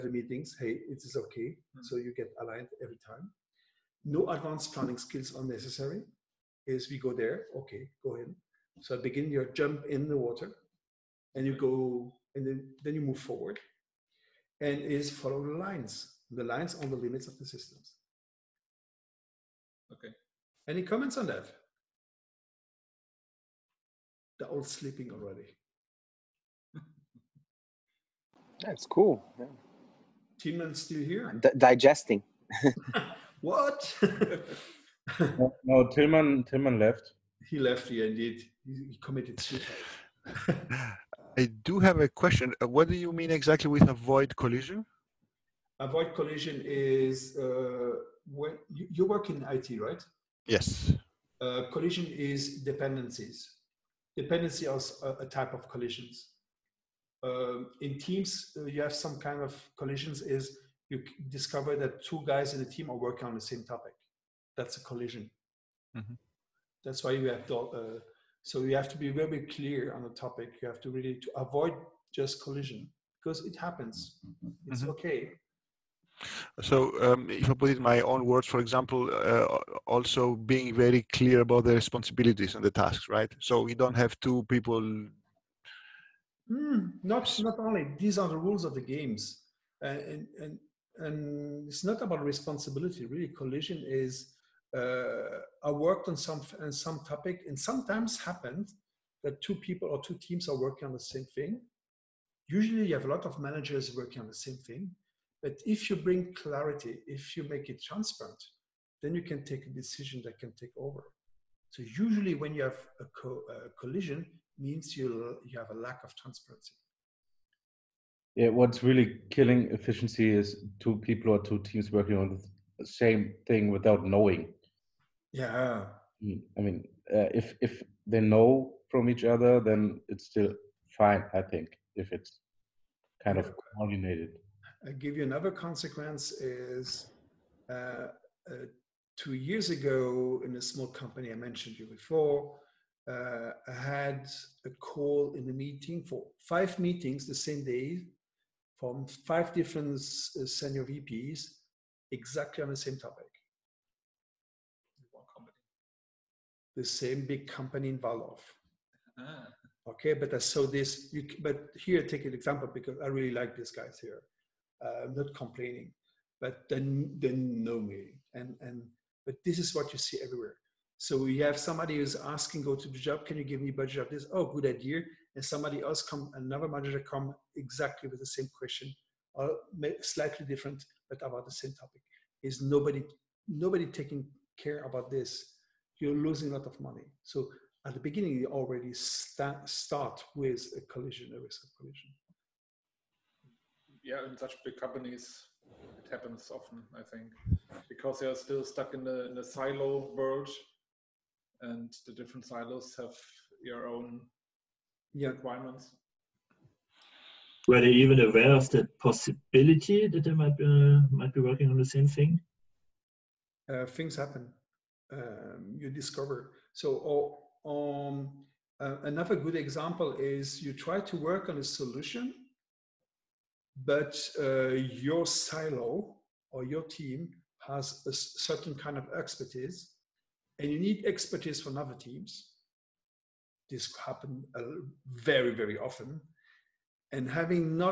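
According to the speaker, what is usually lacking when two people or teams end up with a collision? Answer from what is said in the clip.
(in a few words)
Transparency.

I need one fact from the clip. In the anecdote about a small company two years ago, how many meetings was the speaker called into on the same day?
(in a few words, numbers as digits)
5.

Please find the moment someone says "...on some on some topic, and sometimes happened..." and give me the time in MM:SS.
01:36.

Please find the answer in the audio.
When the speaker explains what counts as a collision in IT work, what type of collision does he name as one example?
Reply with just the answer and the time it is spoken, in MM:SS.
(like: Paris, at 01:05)
Dependencies, at 00:54.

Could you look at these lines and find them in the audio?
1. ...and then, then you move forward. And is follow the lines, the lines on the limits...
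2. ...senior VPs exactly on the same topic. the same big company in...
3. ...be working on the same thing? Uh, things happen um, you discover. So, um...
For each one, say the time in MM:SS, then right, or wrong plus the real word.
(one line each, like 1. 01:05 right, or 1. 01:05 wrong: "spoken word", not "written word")
1. 00:12 right
2. 02:30 right
3. 03:31 right.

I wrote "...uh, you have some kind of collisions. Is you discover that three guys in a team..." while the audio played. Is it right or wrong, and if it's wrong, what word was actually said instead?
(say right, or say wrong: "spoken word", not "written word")
wrong: "two", not "three".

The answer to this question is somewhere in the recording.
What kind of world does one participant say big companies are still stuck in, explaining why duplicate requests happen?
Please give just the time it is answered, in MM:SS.
03:19.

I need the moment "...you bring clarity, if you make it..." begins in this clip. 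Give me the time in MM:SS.
01:45.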